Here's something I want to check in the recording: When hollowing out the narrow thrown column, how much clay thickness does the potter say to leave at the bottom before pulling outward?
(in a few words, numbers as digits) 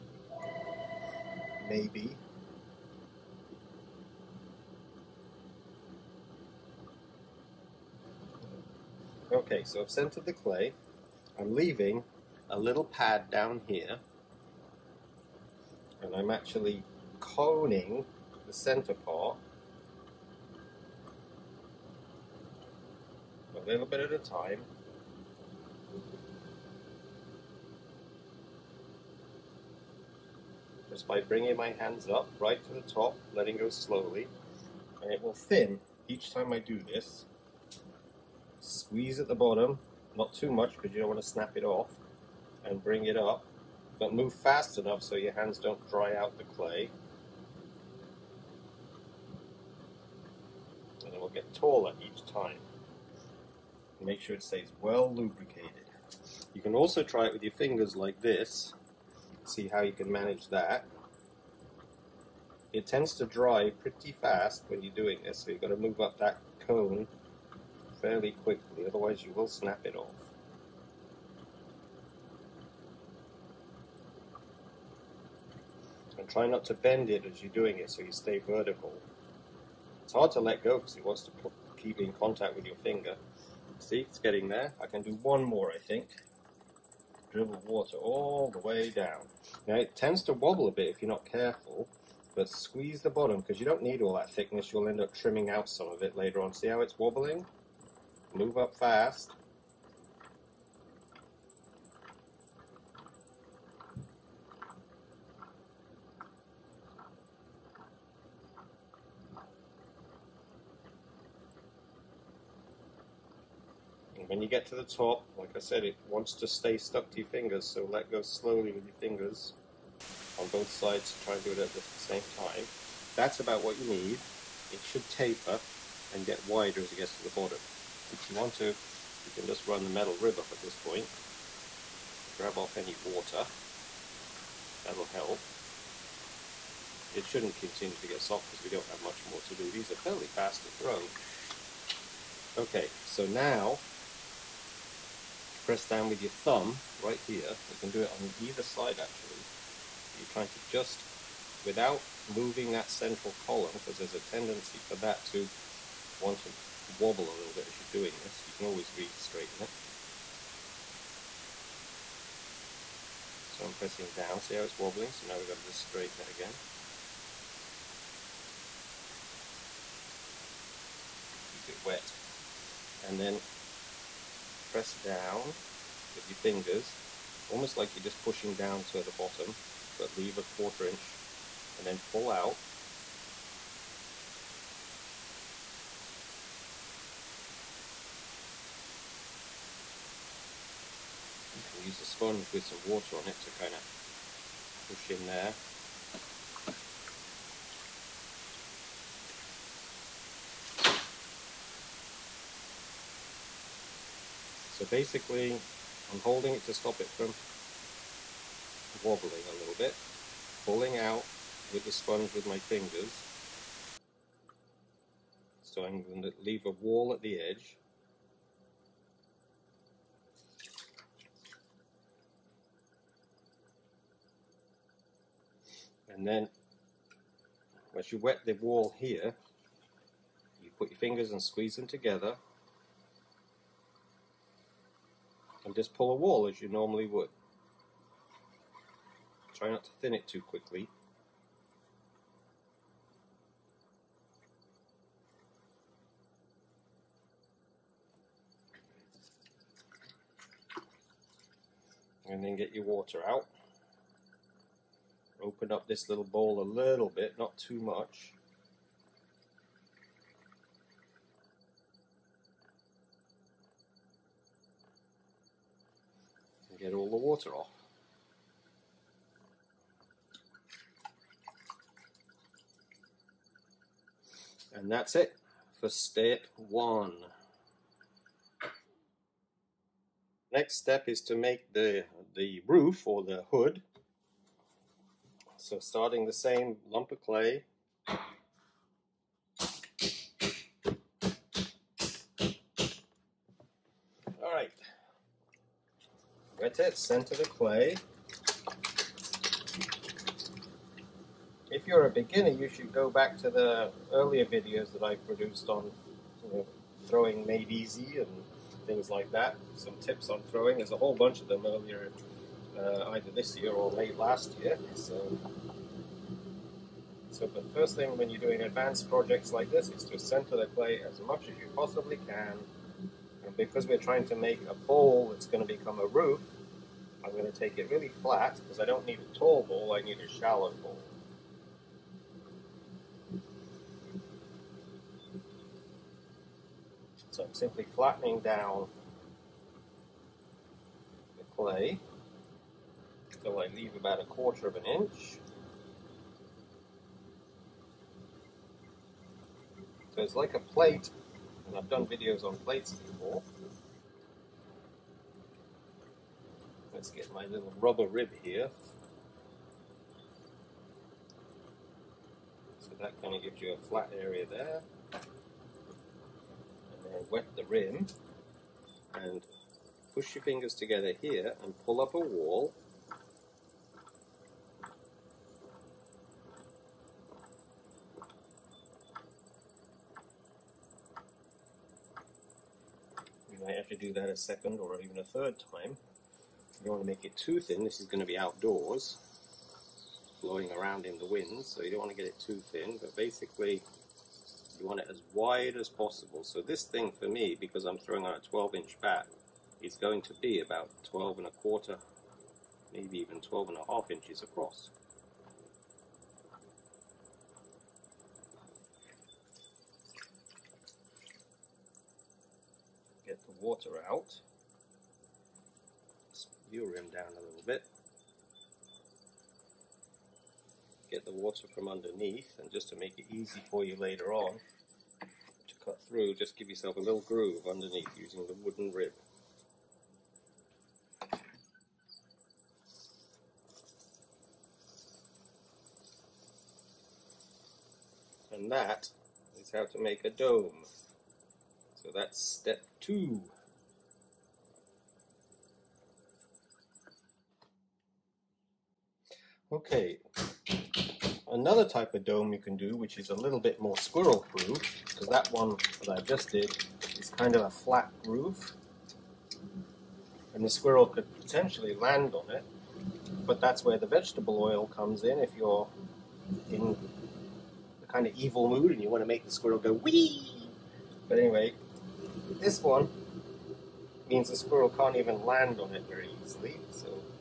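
a quarter inch.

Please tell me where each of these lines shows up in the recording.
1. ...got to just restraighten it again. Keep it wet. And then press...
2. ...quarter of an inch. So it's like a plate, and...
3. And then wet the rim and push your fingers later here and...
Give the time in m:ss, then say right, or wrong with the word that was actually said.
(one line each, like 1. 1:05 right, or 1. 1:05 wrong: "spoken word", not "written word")
1. 2:45 wrong: "straighten", not "restraighten"
2. 5:44 right
3. 6:05 wrong: "together", not "later".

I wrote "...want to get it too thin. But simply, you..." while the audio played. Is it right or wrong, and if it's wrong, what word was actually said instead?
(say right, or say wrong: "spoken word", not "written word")
wrong: "basically", not "simply".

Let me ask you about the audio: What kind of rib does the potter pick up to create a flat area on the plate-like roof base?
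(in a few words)
rubber rib.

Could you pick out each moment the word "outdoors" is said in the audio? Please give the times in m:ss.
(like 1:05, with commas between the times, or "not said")
6:28.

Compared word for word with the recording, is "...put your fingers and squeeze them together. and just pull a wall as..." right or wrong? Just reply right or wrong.
right.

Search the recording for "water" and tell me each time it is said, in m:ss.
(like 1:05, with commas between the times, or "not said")
1:27, 2:13, 3:12, 4:12, 4:27, 6:53, 7:01.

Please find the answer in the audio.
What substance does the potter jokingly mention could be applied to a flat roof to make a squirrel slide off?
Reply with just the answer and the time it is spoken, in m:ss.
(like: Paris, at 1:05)
vegetable oil, at 7:44.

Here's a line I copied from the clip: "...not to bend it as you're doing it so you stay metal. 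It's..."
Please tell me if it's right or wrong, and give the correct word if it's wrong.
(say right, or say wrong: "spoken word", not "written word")
wrong: "vertical", not "metal".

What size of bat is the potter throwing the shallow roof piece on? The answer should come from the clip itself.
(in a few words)
12 inch.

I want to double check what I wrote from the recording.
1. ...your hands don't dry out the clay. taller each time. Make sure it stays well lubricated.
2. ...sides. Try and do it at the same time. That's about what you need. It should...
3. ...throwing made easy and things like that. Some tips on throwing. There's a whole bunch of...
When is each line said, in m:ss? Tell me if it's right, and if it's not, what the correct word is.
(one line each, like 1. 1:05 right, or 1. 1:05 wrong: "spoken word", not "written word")
1. 0:45 right
2. 2:00 right
3. 5:07 right.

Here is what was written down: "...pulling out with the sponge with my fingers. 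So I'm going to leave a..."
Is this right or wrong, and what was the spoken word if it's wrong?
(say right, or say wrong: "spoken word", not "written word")
right.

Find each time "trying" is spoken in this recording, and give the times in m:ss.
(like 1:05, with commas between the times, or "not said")
2:30, 5:23.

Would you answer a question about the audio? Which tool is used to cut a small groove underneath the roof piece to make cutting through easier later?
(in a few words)
wooden rib.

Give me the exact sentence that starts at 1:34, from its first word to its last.
You'll end up trimming out some of it later on.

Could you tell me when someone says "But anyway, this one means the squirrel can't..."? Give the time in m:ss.
7:51.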